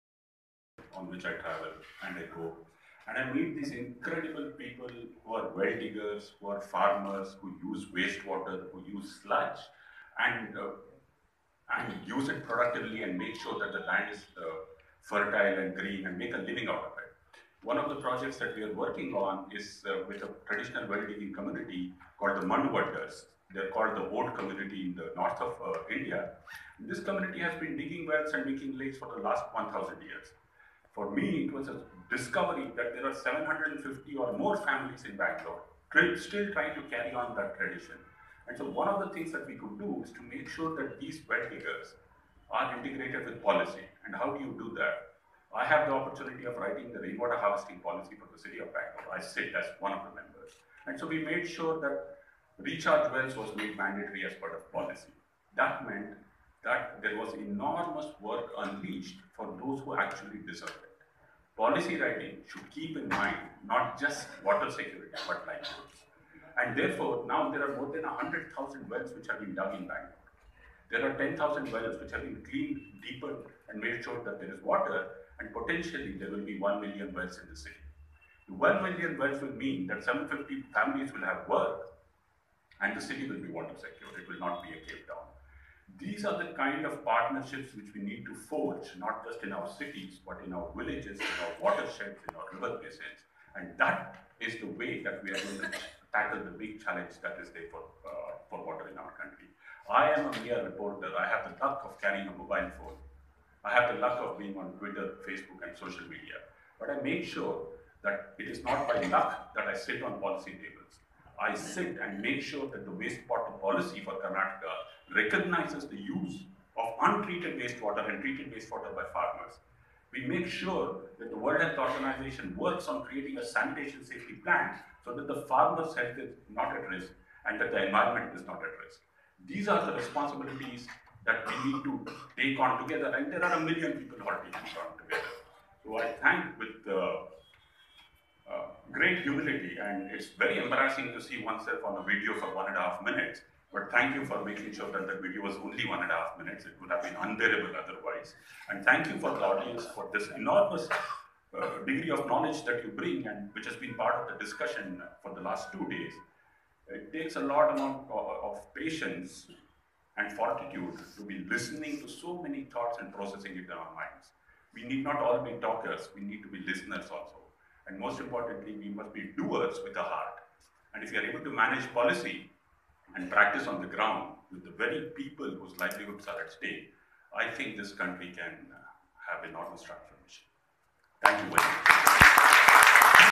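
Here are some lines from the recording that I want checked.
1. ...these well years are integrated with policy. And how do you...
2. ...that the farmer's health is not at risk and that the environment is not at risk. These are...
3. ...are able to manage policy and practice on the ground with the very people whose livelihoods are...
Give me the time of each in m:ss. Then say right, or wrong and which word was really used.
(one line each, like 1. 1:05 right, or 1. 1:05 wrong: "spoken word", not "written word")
1. 0:41 wrong: "diggers", not "years"
2. 2:05 right
3. 2:51 right.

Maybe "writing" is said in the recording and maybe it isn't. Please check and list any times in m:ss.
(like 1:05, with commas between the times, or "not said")
0:46, 1:01.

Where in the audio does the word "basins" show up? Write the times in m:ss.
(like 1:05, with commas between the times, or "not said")
1:32.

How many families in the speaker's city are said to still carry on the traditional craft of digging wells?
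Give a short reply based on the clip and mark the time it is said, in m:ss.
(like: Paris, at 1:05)
750, at 0:33.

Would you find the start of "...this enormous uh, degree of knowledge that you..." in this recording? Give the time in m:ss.
2:30.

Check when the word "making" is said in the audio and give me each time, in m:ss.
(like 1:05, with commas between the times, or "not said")
0:28, 2:24.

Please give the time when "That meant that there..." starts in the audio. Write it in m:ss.
0:55.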